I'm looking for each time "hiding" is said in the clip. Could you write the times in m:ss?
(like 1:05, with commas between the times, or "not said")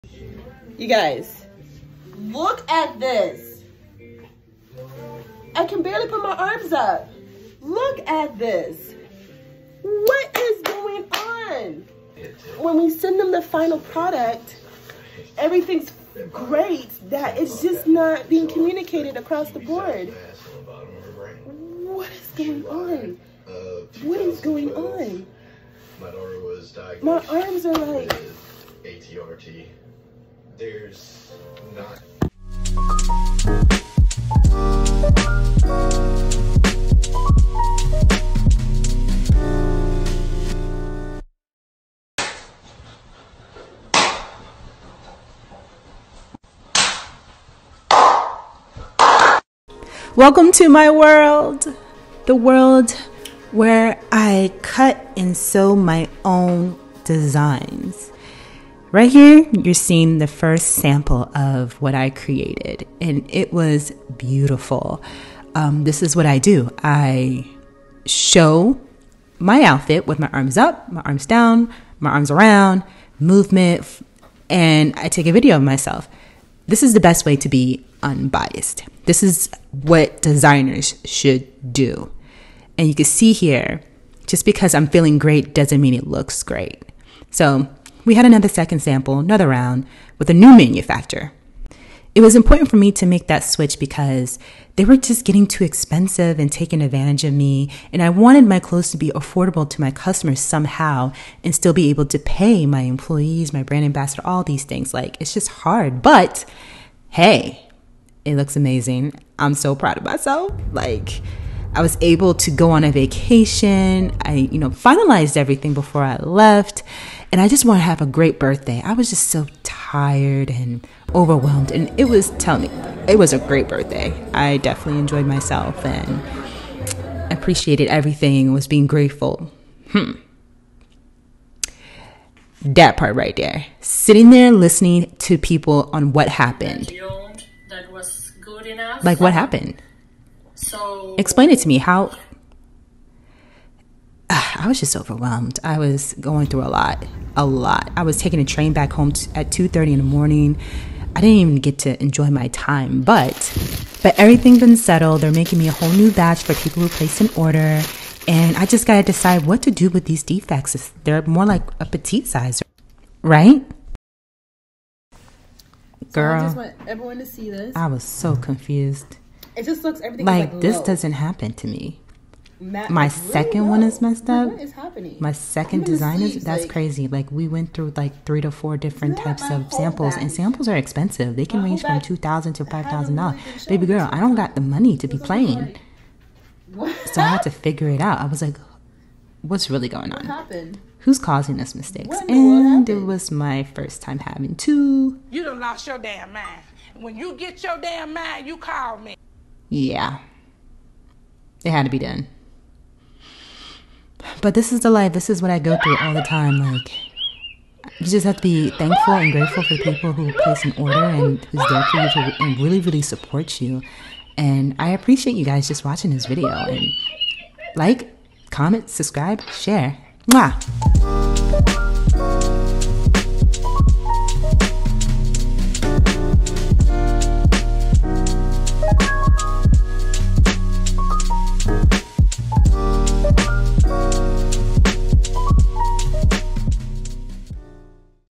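not said.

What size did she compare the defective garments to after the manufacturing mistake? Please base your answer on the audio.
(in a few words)
petite.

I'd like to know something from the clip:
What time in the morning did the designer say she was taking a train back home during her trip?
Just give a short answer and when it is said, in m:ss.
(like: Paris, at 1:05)
2:30, at 2:29.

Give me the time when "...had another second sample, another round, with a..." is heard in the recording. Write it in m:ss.
1:28.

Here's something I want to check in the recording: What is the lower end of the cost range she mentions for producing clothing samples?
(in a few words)
$2,000.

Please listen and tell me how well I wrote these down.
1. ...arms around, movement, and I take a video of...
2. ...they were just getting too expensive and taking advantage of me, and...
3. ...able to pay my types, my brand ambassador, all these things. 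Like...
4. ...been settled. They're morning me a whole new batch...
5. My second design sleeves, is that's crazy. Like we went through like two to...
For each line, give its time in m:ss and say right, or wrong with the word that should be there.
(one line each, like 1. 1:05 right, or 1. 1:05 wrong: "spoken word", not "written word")
1. 1:12 right
2. 1:34 right
3. 1:41 wrong: "employees", not "types"
4. 2:34 wrong: "making", not "morning"
5. 2:55 wrong: "three", not "two".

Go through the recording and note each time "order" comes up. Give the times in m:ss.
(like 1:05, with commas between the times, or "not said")
2:37, 3:30.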